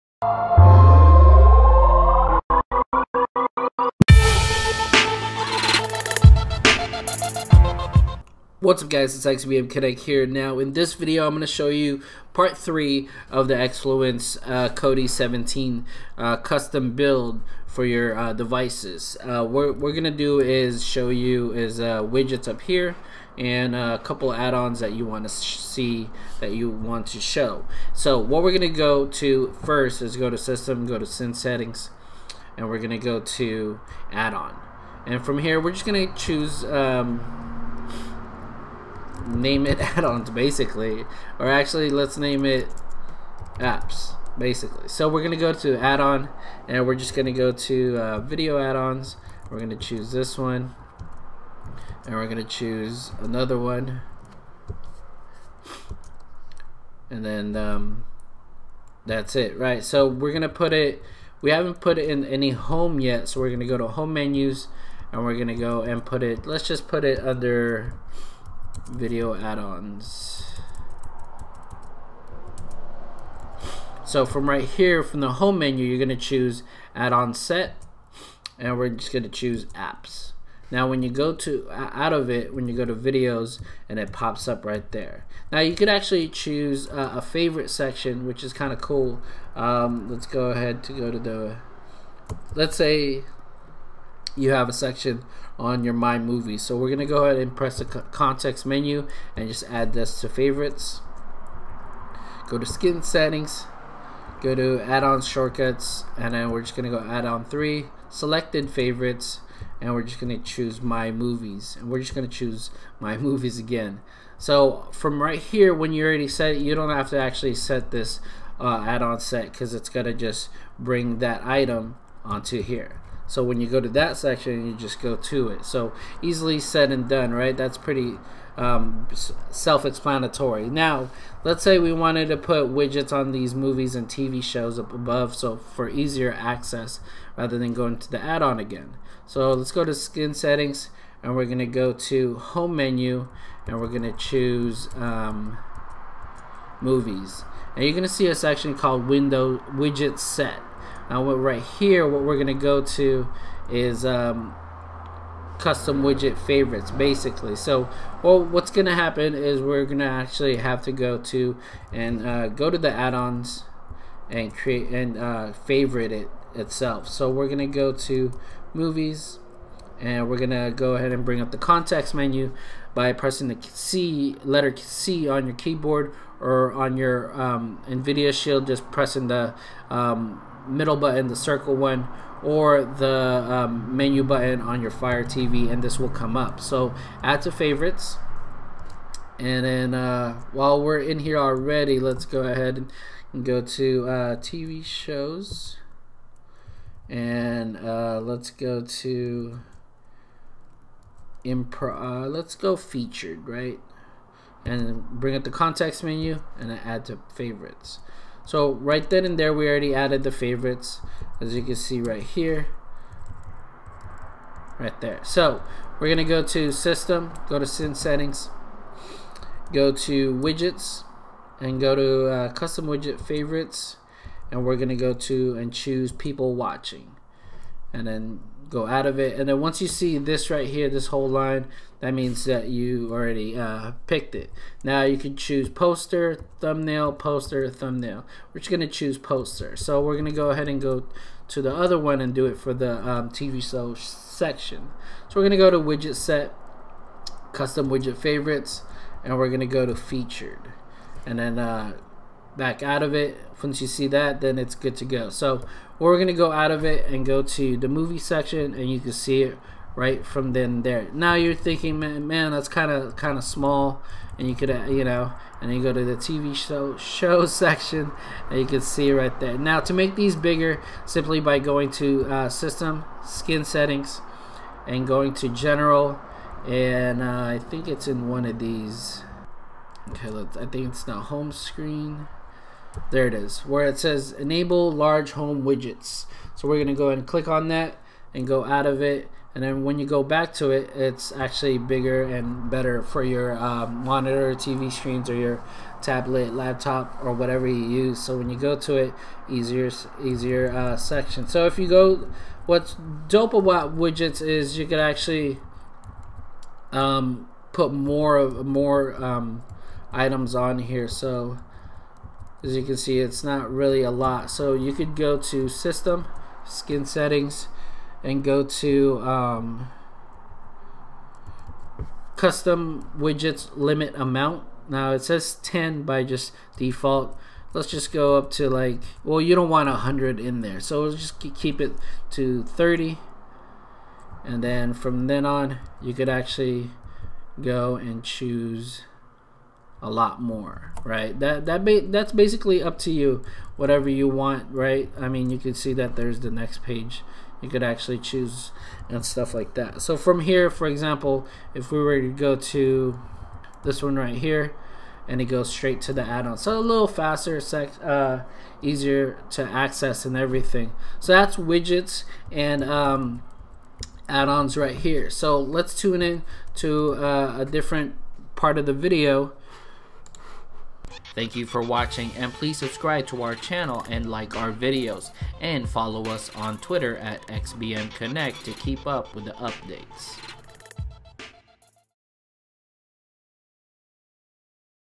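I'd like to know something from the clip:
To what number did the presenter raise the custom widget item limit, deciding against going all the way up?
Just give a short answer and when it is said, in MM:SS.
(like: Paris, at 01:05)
30, at 05:32.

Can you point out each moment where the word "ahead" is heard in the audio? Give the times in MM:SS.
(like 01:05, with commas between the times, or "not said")
01:30, 01:37, 02:50, 03:12, 04:00.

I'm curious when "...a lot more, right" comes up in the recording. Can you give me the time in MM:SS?
05:40.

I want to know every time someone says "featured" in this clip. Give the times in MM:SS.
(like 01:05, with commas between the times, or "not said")
03:22, 04:09.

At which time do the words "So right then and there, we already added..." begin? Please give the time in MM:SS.
03:28.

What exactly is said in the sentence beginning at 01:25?
Now you could actually choose uh, a favorite section, which is kind of cool.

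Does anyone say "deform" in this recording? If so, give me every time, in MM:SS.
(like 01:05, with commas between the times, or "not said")
not said.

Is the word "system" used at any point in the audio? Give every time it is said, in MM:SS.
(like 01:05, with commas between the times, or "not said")
00:30, 03:36, 04:32, 05:15.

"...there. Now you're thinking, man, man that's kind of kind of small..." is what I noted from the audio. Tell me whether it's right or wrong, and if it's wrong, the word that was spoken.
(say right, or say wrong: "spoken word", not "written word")
right.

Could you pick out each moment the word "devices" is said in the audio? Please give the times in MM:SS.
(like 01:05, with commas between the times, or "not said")
00:18.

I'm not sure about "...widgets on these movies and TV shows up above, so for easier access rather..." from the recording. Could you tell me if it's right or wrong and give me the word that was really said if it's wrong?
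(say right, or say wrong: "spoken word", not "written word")
right.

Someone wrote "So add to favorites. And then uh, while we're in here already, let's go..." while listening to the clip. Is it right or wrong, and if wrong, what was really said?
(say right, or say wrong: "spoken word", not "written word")
right.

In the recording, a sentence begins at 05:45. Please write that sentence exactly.
I mean, you can see that there's the next page.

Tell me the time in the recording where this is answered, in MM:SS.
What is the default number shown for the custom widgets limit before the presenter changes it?
05:25.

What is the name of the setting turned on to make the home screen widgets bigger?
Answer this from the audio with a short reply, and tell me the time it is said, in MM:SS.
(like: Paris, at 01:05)
enable large home widgets, at 04:44.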